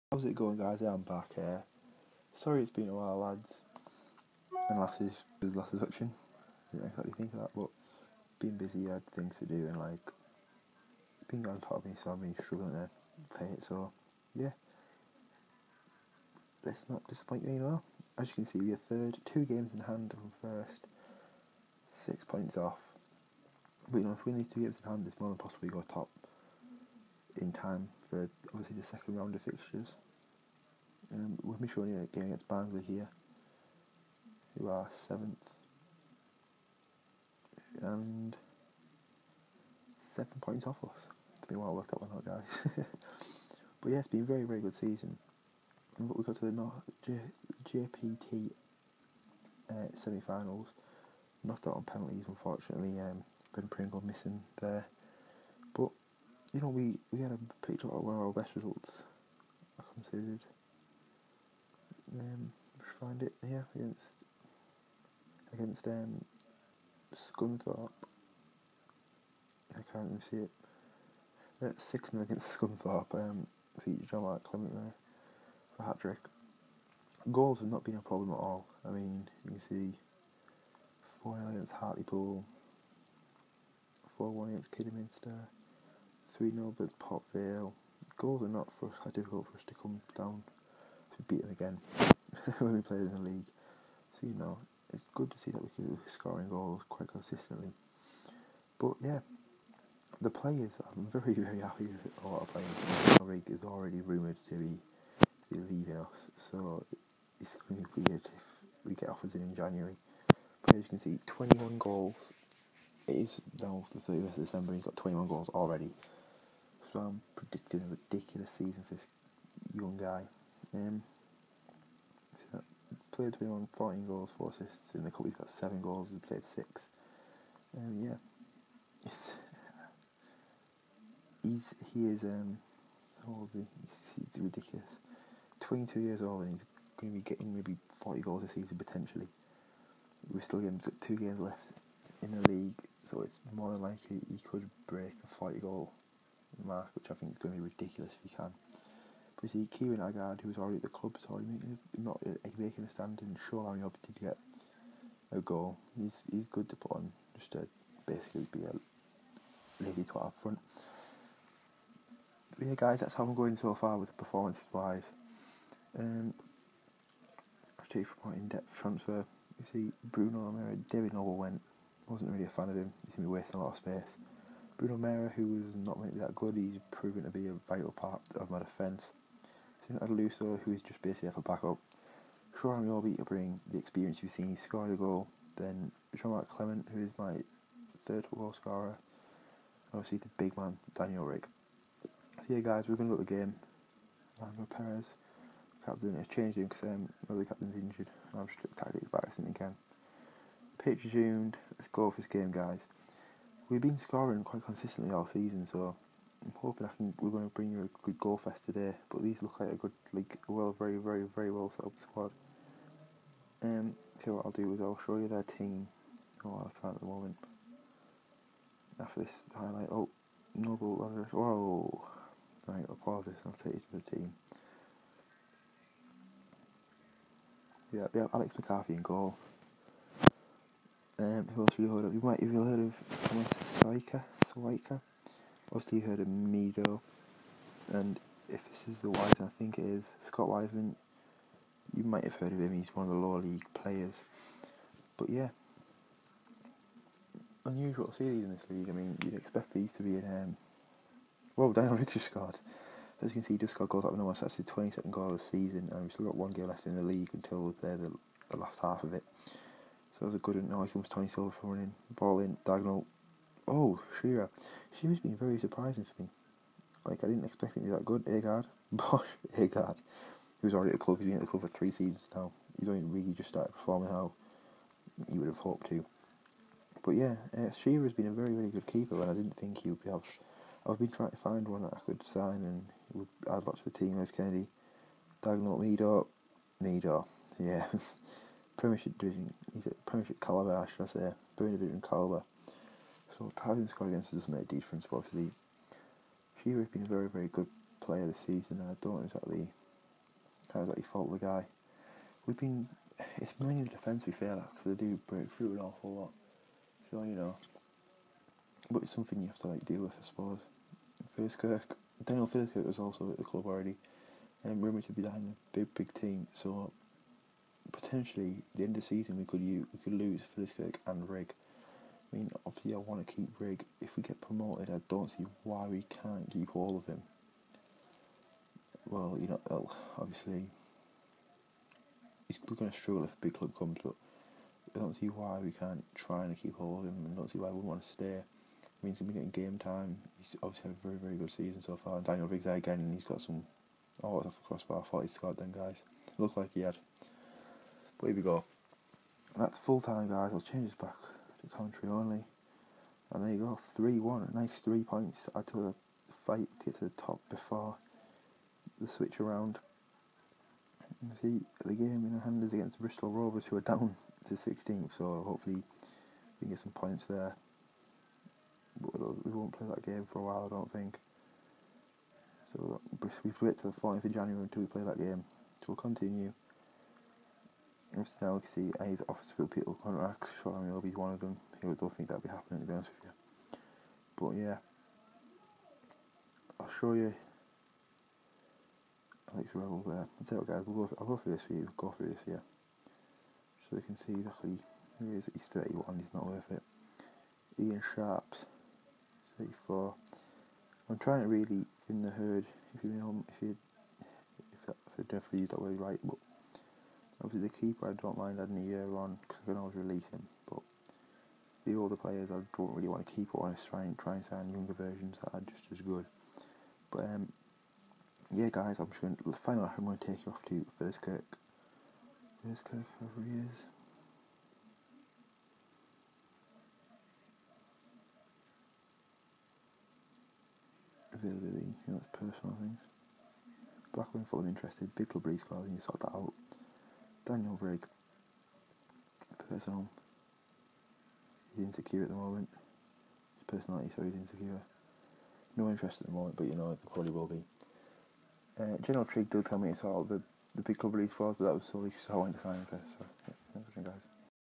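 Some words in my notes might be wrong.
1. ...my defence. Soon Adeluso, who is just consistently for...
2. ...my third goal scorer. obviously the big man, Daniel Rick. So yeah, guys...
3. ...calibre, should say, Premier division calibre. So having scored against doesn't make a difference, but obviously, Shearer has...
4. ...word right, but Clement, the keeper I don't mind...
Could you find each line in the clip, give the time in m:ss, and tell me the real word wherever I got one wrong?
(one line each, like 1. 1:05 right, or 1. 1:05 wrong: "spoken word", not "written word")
1. 2:58 wrong: "basically", not "consistently"
2. 3:07 right
3. 4:50 right
4. 6:45 wrong: "Obviously", not "Clement".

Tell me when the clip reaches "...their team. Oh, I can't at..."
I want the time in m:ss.
3:35.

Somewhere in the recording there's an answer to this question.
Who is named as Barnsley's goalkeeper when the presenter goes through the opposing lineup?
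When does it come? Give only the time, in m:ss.
3:48.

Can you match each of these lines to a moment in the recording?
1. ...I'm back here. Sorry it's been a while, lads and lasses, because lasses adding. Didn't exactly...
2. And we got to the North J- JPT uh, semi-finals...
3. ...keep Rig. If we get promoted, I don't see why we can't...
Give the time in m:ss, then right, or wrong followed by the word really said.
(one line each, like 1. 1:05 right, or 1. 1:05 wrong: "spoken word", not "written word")
1. 0:00 wrong: "watching", not "adding"
2. 0:45 right
3. 5:23 right.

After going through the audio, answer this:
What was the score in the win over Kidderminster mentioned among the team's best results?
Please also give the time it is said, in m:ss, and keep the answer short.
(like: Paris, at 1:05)
4-1, at 1:24.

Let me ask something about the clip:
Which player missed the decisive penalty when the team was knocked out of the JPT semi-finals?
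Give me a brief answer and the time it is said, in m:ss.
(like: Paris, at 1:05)
Ben Pringle, at 0:53.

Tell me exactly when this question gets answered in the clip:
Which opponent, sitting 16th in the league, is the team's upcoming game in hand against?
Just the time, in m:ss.
6:02.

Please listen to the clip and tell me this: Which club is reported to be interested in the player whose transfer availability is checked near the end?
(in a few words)
Blackburn.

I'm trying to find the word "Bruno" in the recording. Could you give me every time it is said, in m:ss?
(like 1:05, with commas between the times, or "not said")
2:50, 2:54.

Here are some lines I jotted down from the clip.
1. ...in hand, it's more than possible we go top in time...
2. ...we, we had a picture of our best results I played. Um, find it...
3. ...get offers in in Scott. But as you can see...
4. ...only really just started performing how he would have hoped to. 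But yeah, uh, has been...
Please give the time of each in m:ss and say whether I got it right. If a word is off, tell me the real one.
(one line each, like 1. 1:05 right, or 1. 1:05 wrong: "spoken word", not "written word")
1. 0:24 right
2. 0:56 wrong: "considered", not "played"
3. 1:48 wrong: "January", not "Scott"
4. 4:32 right.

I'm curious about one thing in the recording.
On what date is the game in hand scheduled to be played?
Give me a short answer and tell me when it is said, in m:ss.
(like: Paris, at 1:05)
14th of January, at 6:14.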